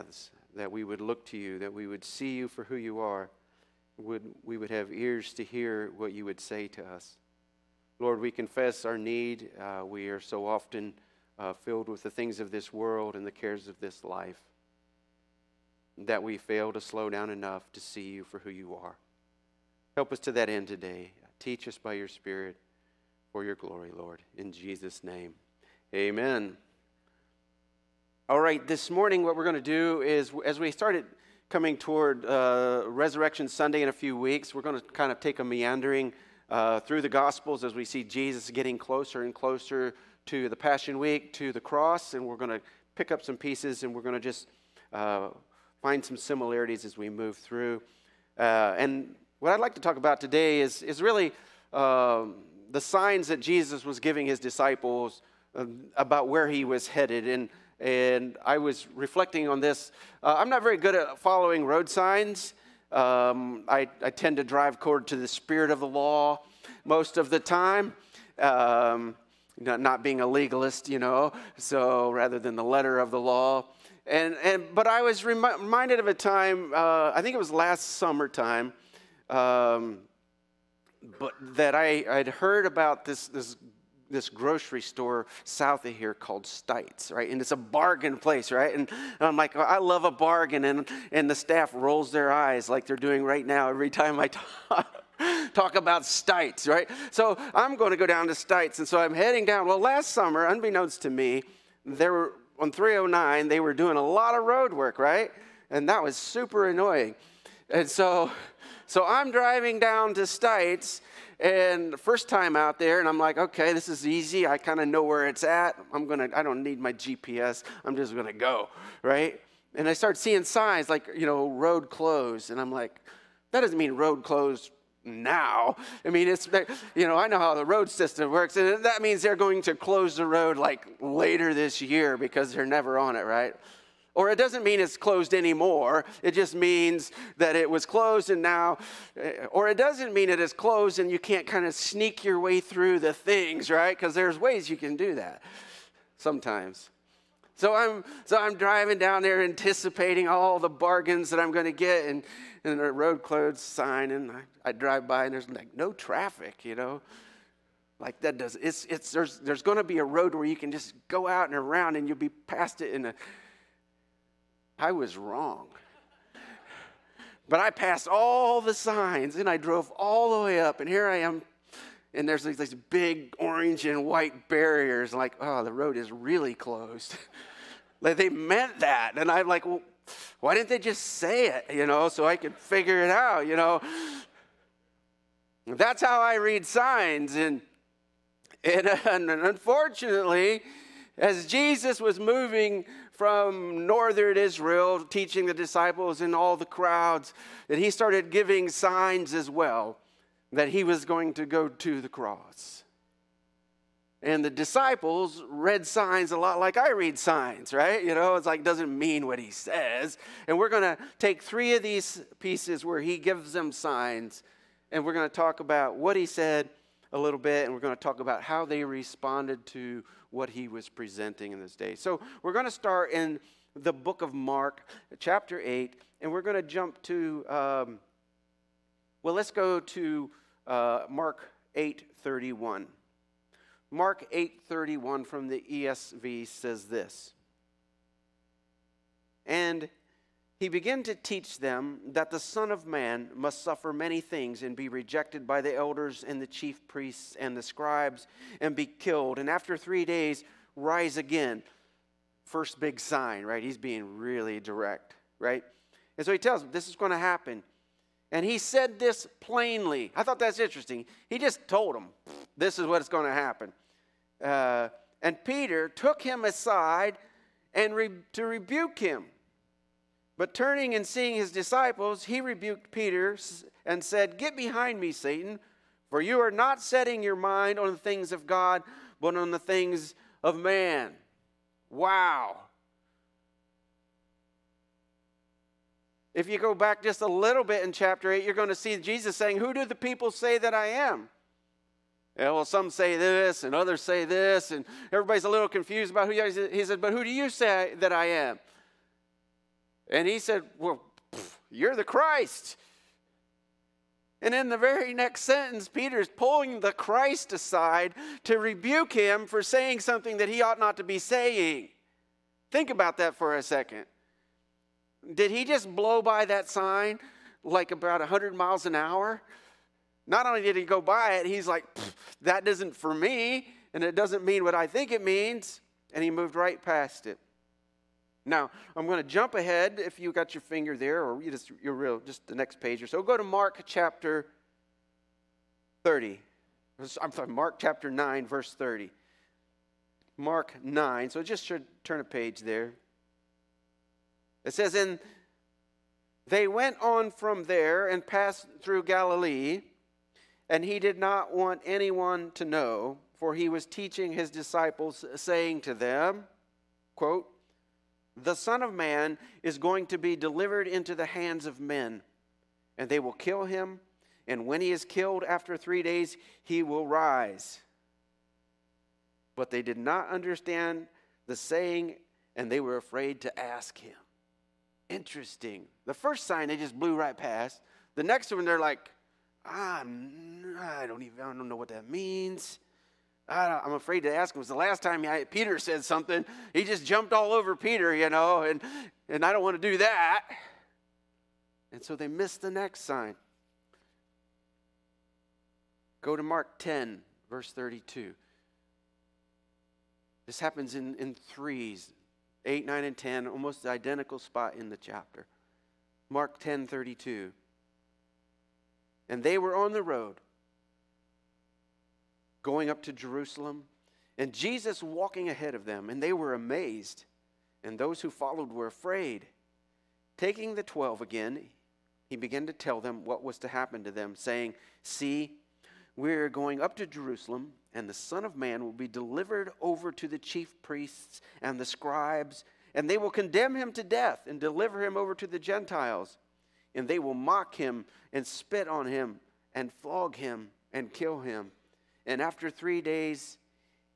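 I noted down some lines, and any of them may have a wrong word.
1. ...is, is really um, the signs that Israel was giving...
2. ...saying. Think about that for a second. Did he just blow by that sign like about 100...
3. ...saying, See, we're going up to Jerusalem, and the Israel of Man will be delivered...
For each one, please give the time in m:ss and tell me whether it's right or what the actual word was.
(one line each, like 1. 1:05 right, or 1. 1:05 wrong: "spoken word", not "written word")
1. 0:50 wrong: "Jesus", not "Israel"
2. 5:11 right
3. 7:04 wrong: "Son", not "Israel".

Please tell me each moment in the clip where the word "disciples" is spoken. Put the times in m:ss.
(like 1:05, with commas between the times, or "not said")
0:54, 3:15, 3:24, 4:31, 5:54.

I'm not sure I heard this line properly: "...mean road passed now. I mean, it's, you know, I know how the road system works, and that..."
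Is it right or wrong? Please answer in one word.
wrong.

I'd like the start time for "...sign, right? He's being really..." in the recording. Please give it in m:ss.
4:12.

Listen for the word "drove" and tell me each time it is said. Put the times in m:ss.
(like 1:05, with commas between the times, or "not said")
2:49.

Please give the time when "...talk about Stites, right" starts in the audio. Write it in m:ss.
1:35.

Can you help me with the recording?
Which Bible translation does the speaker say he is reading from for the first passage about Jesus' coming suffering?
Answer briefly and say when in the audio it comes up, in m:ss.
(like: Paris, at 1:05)
ESV, at 3:55.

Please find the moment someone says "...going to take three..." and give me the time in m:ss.
3:30.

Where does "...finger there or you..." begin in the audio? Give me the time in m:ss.
5:30.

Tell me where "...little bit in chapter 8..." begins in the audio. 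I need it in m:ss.
4:47.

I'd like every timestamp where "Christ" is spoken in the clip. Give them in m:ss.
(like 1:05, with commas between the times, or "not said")
5:02, 5:06.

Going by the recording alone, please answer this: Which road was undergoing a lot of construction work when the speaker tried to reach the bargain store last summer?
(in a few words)
309.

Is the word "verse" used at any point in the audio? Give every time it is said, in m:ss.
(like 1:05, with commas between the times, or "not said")
5:38, 6:37.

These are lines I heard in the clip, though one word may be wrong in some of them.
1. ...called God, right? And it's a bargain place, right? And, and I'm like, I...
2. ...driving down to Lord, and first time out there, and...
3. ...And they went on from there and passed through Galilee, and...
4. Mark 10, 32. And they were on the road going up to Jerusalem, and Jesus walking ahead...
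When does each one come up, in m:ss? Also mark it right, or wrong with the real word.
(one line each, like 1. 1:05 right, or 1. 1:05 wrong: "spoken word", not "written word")
1. 1:26 wrong: "Stites", not "God"
2. 1:49 wrong: "Stites", not "Lord"
3. 5:44 right
4. 6:46 right.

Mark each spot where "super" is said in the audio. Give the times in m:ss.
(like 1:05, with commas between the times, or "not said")
1:46.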